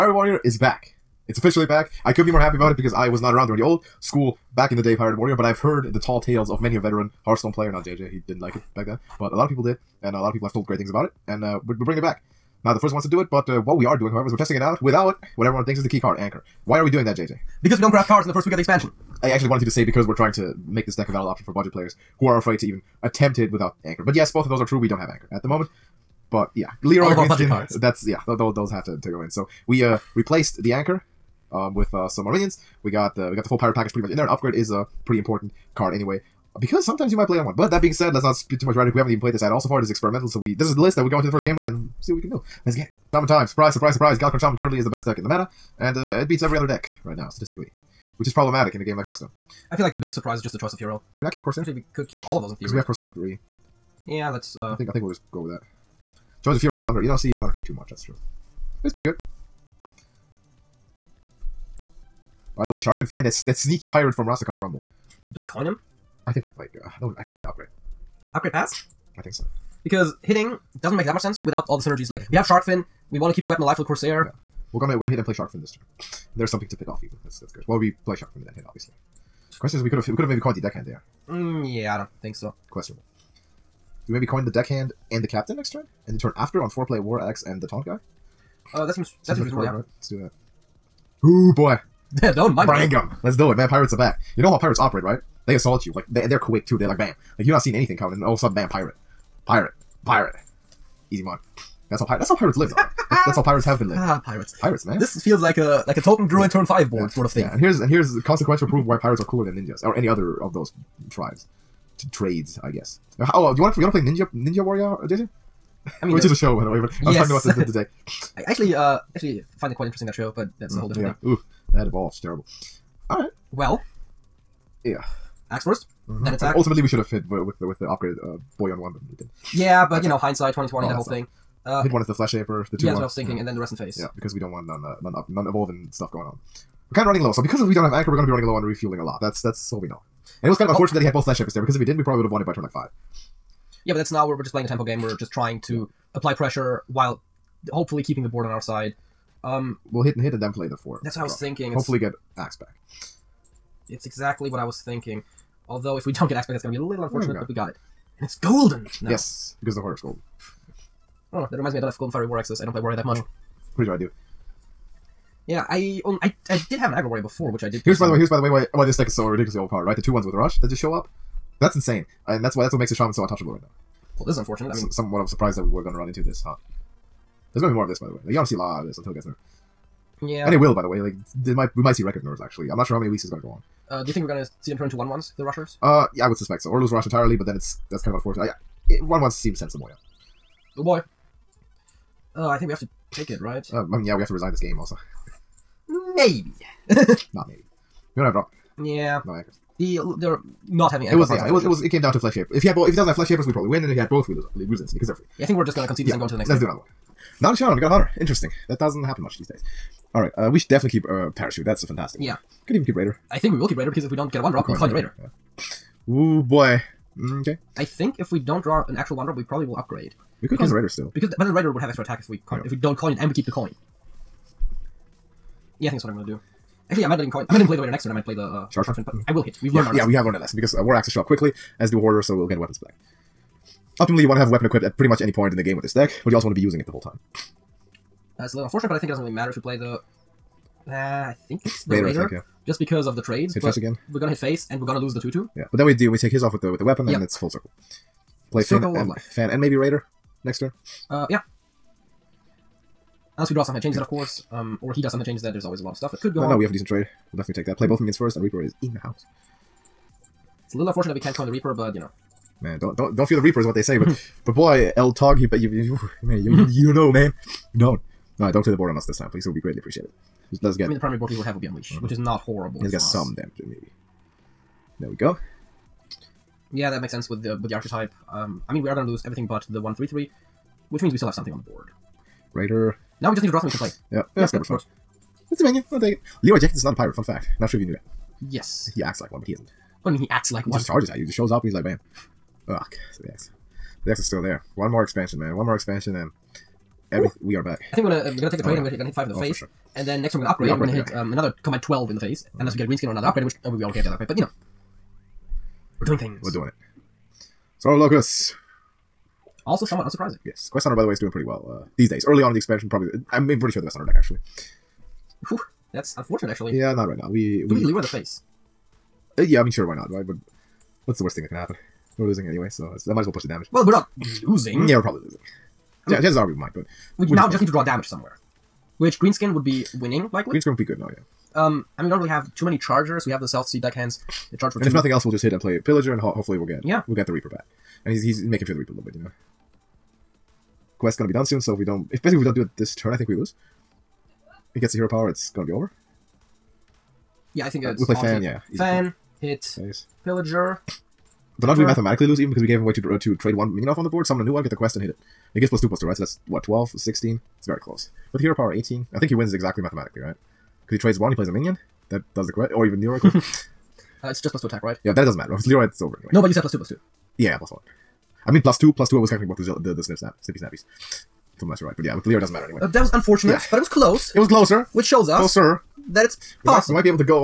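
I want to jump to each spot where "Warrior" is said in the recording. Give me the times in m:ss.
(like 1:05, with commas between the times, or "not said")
0:00, 0:05, 1:54, 2:42, 2:47.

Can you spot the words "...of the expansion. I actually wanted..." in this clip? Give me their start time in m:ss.
0:18.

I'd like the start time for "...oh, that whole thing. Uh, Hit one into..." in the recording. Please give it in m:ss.
2:10.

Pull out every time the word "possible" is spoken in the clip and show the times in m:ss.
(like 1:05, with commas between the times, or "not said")
6:16.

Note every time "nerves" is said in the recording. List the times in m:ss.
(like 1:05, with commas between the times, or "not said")
3:02.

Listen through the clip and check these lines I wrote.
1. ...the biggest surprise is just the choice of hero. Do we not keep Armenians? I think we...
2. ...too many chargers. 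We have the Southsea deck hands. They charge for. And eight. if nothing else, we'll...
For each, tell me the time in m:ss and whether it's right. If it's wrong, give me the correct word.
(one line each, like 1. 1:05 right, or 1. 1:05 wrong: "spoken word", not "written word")
1. 0:49 wrong: "Corsair", not "Armenians"
2. 5:32 wrong: "two", not "eight".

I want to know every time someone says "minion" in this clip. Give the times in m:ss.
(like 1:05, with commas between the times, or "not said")
4:17, 5:53, 6:01.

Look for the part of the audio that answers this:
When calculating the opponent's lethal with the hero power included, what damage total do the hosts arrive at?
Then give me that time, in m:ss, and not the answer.
5:58.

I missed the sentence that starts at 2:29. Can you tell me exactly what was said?
Um, we'll hit and hit and then play the four.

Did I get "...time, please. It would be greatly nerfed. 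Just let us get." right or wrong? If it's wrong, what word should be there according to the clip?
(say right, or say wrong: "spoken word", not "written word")
wrong: "appreciated", not "nerfed".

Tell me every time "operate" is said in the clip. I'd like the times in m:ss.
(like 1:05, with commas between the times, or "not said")
1:34.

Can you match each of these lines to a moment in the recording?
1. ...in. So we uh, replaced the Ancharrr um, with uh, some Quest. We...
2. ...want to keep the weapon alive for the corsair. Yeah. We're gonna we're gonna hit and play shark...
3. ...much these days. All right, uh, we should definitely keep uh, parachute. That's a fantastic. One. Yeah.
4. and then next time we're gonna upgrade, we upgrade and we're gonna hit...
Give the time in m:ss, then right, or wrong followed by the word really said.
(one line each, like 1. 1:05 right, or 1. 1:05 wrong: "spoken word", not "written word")
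1. 0:29 wrong: "Armenians", not "Quest"
2. 1:13 right
3. 3:29 right
4. 4:59 right.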